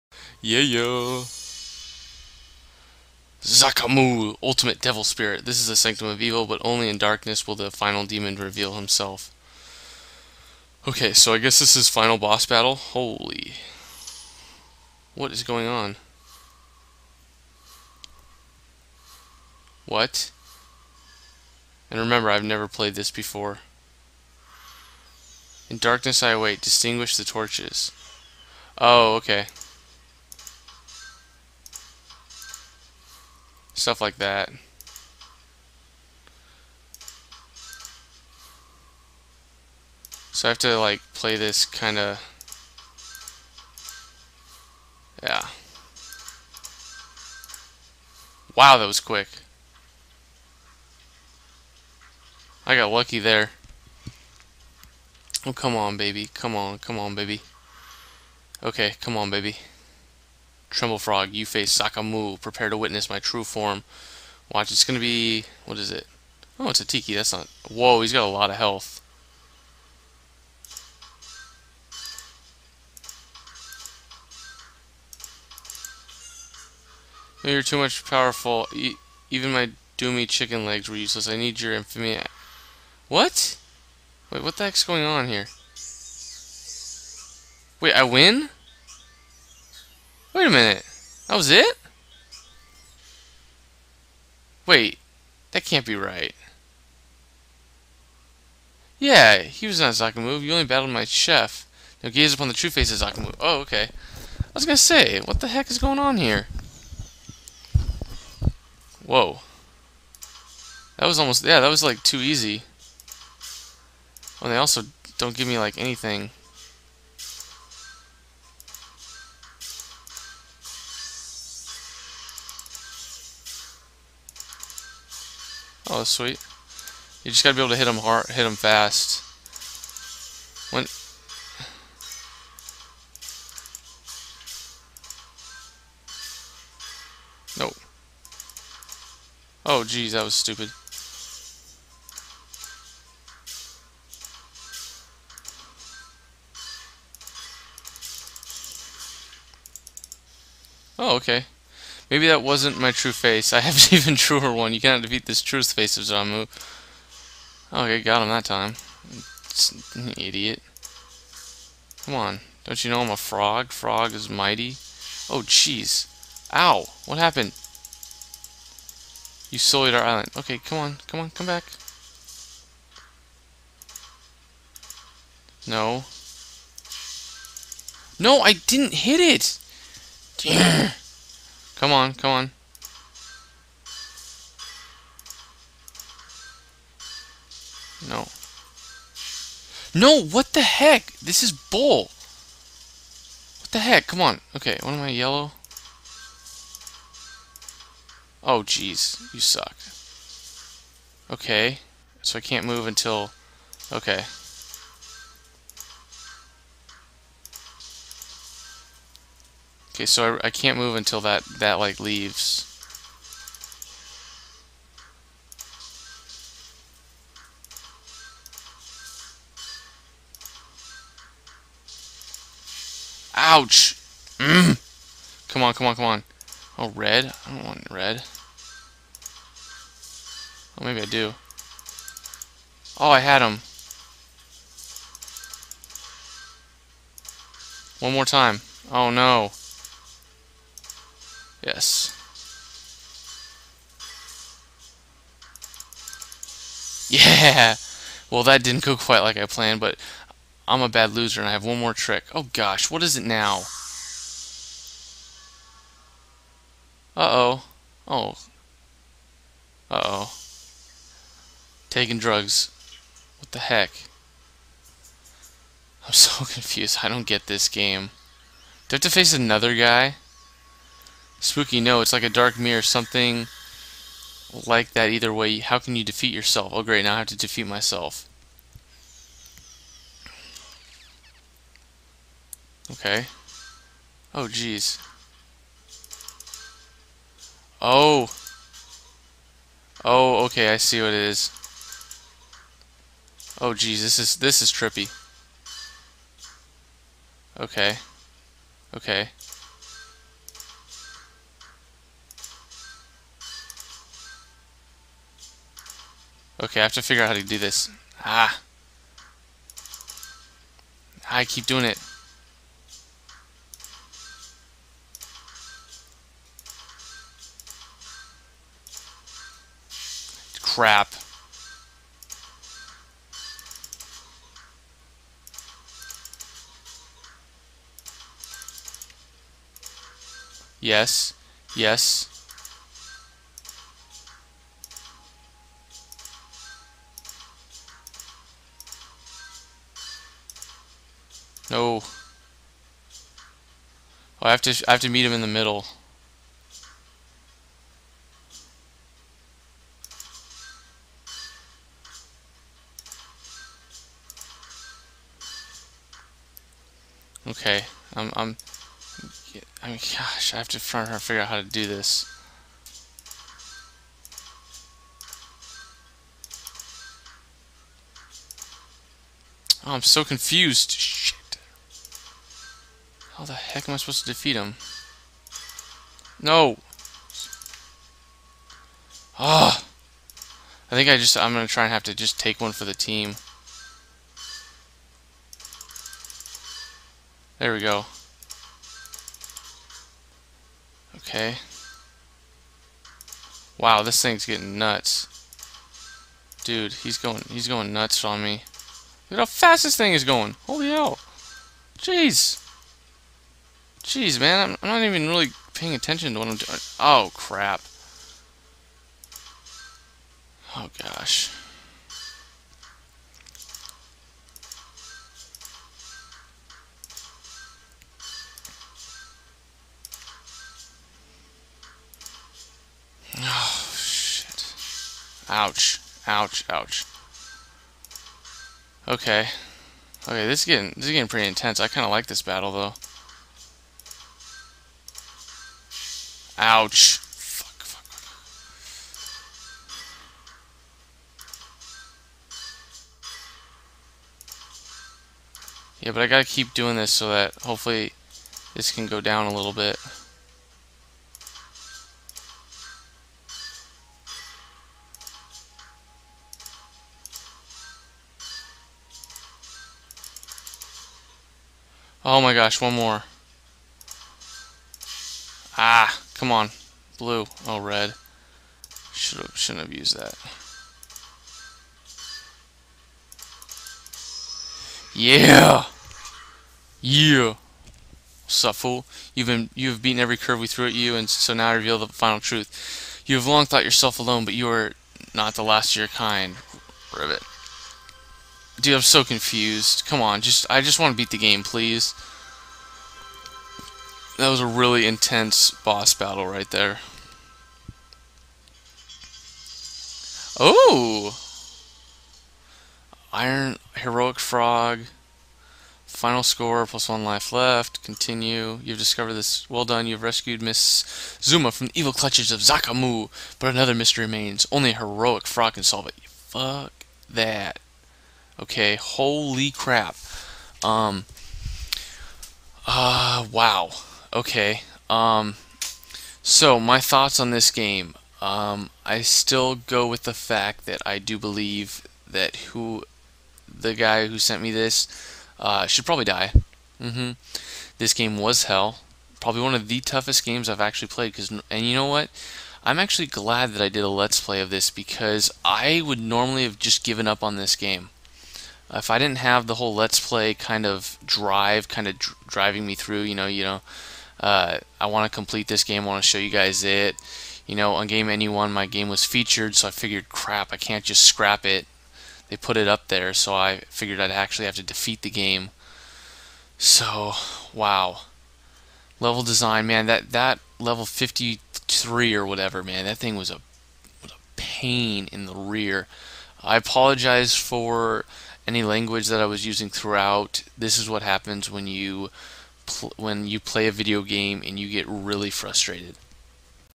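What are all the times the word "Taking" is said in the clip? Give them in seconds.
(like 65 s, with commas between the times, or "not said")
261 s.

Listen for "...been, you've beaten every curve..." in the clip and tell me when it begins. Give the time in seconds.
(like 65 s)
479 s.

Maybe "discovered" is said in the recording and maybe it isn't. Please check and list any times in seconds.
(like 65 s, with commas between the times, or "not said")
508 s.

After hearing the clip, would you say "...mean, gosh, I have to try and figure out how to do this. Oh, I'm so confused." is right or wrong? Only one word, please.
right.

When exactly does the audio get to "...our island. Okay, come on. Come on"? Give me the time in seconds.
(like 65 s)
169 s.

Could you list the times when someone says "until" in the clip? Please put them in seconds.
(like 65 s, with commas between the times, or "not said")
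202 s, 210 s.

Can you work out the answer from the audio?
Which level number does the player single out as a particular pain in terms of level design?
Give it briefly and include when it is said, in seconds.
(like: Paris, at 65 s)
53, at 570 s.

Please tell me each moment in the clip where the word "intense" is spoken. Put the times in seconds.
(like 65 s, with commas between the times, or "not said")
431 s, 495 s.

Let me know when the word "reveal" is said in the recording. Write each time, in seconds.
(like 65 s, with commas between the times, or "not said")
8 s, 481 s.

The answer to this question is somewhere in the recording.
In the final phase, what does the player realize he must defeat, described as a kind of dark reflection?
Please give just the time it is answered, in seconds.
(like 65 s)
277 s.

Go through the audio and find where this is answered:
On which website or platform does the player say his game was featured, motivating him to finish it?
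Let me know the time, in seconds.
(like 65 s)
558 s.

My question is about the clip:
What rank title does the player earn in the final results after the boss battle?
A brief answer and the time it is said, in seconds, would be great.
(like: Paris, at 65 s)
Iron Heroic Frog, at 503 s.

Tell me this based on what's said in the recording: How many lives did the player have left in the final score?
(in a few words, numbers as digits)
1.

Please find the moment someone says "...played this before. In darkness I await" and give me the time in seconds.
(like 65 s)
22 s.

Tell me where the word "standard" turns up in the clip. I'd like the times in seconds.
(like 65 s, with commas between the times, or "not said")
not said.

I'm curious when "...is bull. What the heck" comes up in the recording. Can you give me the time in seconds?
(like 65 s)
191 s.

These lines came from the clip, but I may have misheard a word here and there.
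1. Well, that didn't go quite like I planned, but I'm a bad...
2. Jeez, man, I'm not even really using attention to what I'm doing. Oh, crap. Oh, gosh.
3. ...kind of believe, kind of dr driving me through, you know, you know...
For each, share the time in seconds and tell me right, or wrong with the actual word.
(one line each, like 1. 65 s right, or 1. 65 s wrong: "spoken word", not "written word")
1. 248 s right
2. 404 s wrong: "paying", not "using"
3. 550 s wrong: "drive", not "believe".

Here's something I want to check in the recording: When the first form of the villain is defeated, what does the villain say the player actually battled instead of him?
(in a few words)
my chef.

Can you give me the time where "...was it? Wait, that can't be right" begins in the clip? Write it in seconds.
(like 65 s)
91 s.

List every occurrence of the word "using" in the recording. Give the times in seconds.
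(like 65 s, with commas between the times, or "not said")
579 s.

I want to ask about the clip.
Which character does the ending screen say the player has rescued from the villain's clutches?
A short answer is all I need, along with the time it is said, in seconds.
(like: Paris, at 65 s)
Miss Zuma, at 510 s.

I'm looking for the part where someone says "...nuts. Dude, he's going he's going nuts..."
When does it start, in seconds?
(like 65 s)
394 s.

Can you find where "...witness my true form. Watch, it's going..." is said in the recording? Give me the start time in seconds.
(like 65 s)
62 s.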